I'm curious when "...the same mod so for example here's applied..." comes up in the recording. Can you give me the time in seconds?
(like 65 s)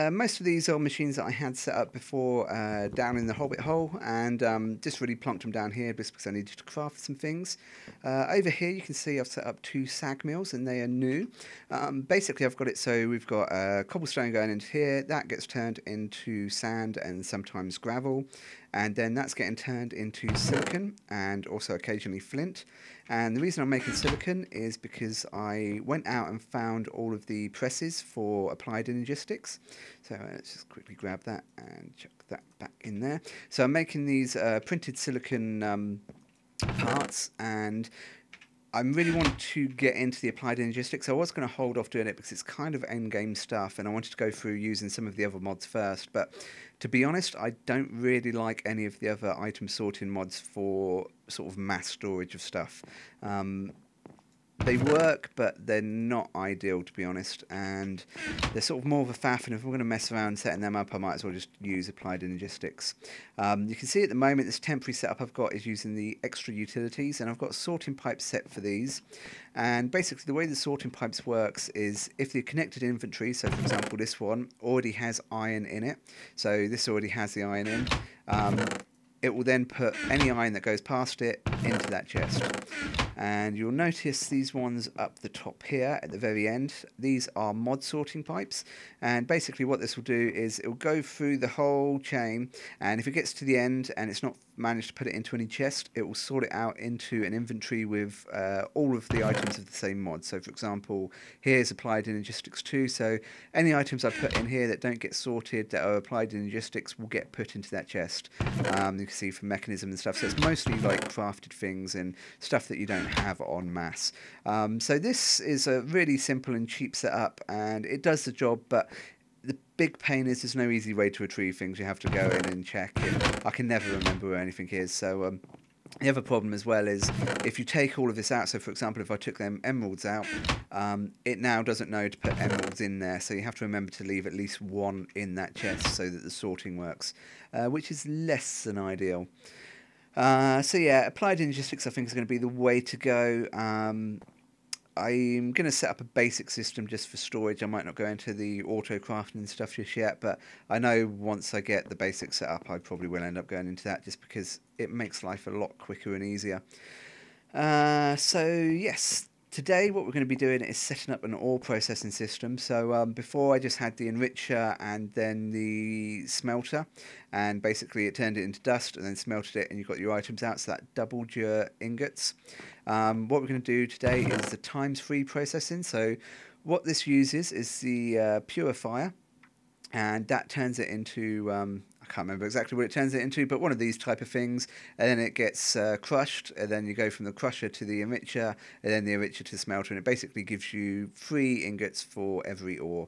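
99 s.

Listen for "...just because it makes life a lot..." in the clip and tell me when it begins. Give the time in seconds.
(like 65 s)
154 s.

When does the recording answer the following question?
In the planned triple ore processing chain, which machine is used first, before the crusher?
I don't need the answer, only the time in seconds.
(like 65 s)
178 s.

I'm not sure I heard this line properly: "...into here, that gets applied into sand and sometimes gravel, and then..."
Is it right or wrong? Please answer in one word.
wrong.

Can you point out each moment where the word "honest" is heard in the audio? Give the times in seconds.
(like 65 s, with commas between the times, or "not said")
47 s, 57 s.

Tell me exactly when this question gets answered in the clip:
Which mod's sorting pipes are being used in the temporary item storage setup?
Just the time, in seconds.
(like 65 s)
66 s.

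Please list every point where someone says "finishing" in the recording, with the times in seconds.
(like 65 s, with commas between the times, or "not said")
not said.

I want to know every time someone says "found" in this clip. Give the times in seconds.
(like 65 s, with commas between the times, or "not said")
26 s.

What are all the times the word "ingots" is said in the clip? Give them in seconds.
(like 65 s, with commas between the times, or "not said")
171 s, 191 s.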